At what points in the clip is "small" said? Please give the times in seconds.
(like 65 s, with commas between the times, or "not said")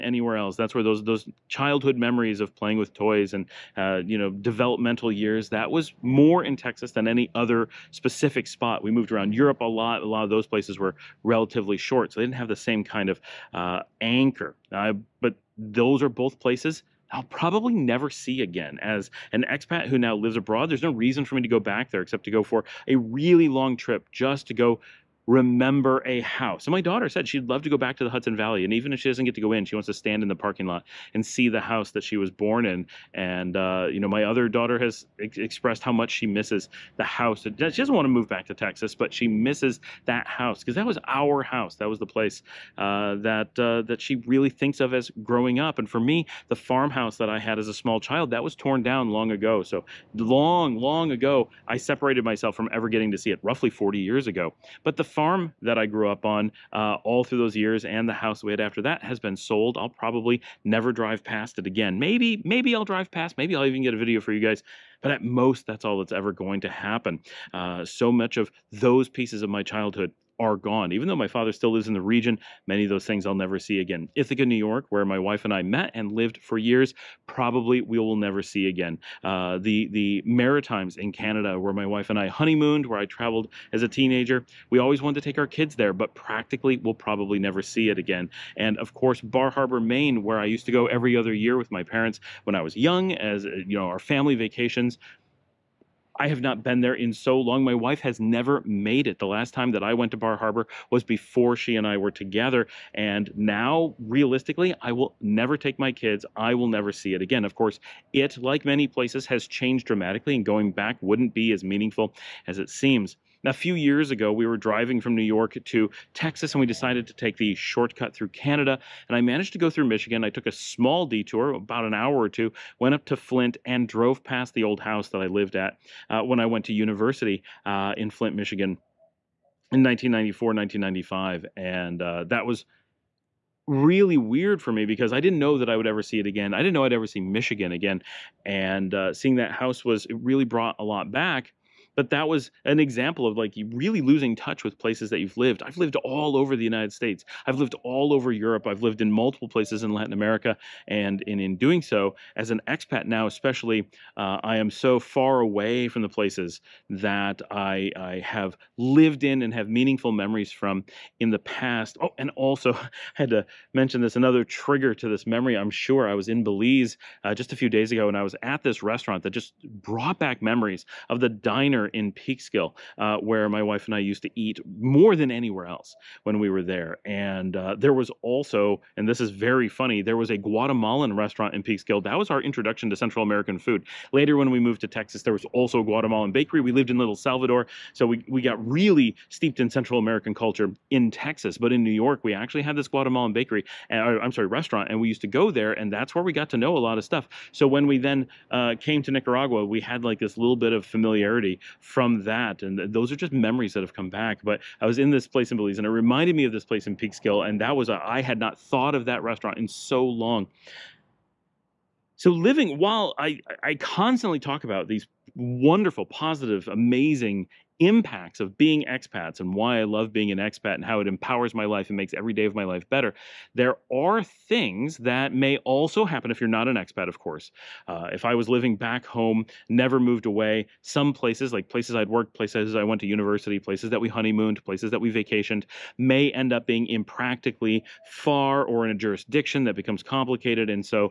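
47 s, 120 s.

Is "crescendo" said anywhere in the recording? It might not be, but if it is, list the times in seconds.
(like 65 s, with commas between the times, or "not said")
not said.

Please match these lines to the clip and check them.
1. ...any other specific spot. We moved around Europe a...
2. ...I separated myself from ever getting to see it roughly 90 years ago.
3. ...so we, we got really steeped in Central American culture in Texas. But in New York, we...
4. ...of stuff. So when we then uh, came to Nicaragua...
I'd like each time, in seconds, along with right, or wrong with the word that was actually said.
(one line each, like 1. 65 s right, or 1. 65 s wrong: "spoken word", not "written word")
1. 7 s right
2. 51 s wrong: "40", not "90"
3. 187 s right
4. 196 s right.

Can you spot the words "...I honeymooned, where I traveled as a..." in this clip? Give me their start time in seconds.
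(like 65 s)
82 s.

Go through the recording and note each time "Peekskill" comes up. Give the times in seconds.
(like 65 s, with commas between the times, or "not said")
172 s, 181 s, 206 s.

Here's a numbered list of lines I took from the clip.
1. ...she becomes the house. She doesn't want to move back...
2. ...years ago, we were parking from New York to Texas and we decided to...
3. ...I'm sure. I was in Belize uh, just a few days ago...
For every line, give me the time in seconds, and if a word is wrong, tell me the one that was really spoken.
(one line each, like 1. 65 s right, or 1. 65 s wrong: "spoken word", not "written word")
1. 36 s wrong: "misses", not "becomes"
2. 113 s wrong: "driving", not "parking"
3. 165 s right.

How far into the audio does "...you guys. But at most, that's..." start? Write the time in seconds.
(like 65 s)
64 s.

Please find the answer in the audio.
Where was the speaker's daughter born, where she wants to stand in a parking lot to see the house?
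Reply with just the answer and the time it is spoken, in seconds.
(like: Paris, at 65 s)
Hudson Valley, at 28 s.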